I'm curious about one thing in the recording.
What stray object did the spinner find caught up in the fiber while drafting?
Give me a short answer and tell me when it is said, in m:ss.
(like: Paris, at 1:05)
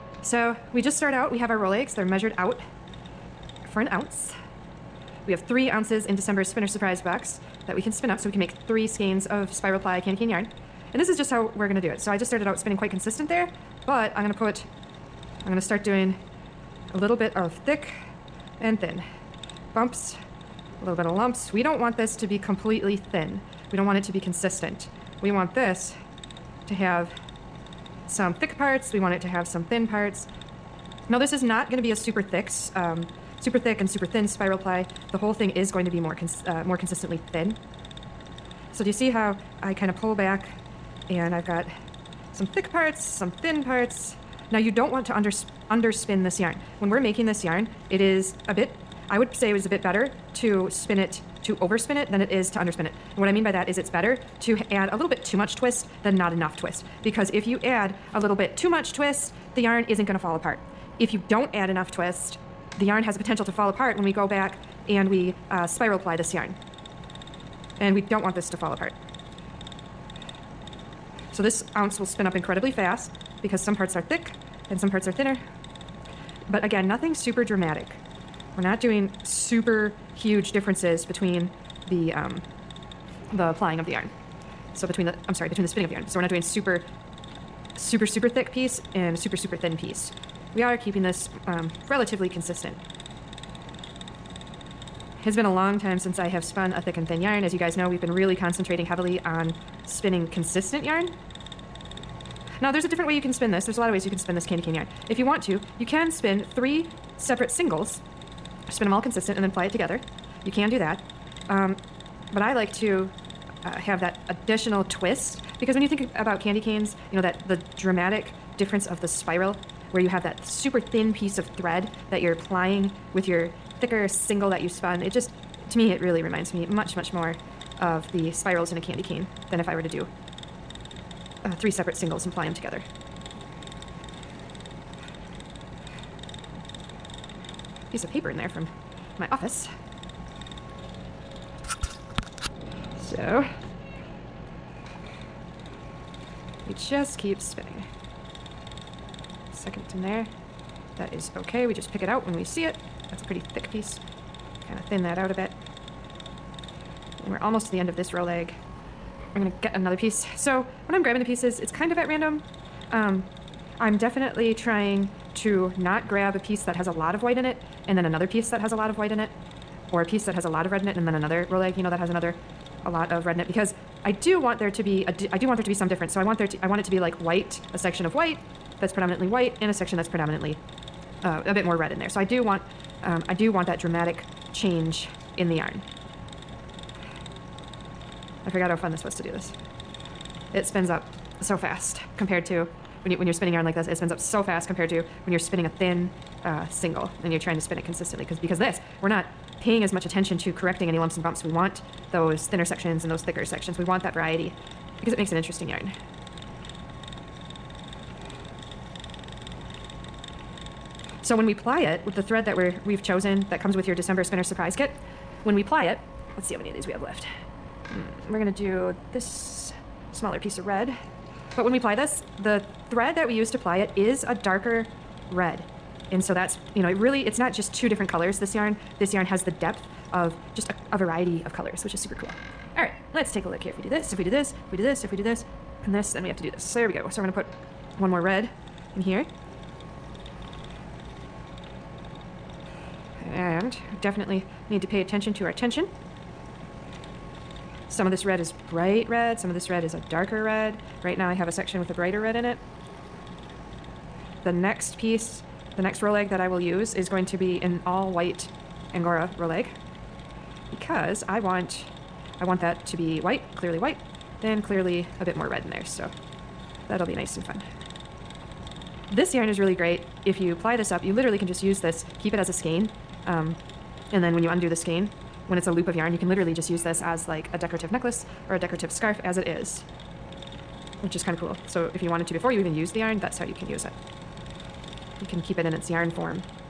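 Piece of paper, at 2:17.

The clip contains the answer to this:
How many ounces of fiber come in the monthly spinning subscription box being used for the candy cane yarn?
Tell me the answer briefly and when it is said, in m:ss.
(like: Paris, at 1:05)
3, at 0:05.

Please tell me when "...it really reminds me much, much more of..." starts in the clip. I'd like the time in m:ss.
2:05.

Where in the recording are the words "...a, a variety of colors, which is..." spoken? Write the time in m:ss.
3:50.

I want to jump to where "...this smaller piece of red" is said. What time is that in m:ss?
3:39.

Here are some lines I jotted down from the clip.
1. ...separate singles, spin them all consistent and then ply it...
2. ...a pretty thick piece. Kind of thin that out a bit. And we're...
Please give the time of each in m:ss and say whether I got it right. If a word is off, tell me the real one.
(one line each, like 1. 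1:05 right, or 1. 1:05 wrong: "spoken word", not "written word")
1. 1:47 right
2. 2:33 right.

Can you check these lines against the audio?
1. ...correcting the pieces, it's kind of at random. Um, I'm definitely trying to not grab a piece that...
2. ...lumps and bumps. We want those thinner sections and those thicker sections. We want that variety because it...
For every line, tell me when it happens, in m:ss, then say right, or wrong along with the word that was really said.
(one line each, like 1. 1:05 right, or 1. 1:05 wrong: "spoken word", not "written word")
1. 2:41 wrong: "grabbing", not "correcting"
2. 3:20 right.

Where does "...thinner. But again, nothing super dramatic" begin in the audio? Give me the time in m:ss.
1:15.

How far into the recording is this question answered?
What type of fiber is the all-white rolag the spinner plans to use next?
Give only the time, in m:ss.
4:18.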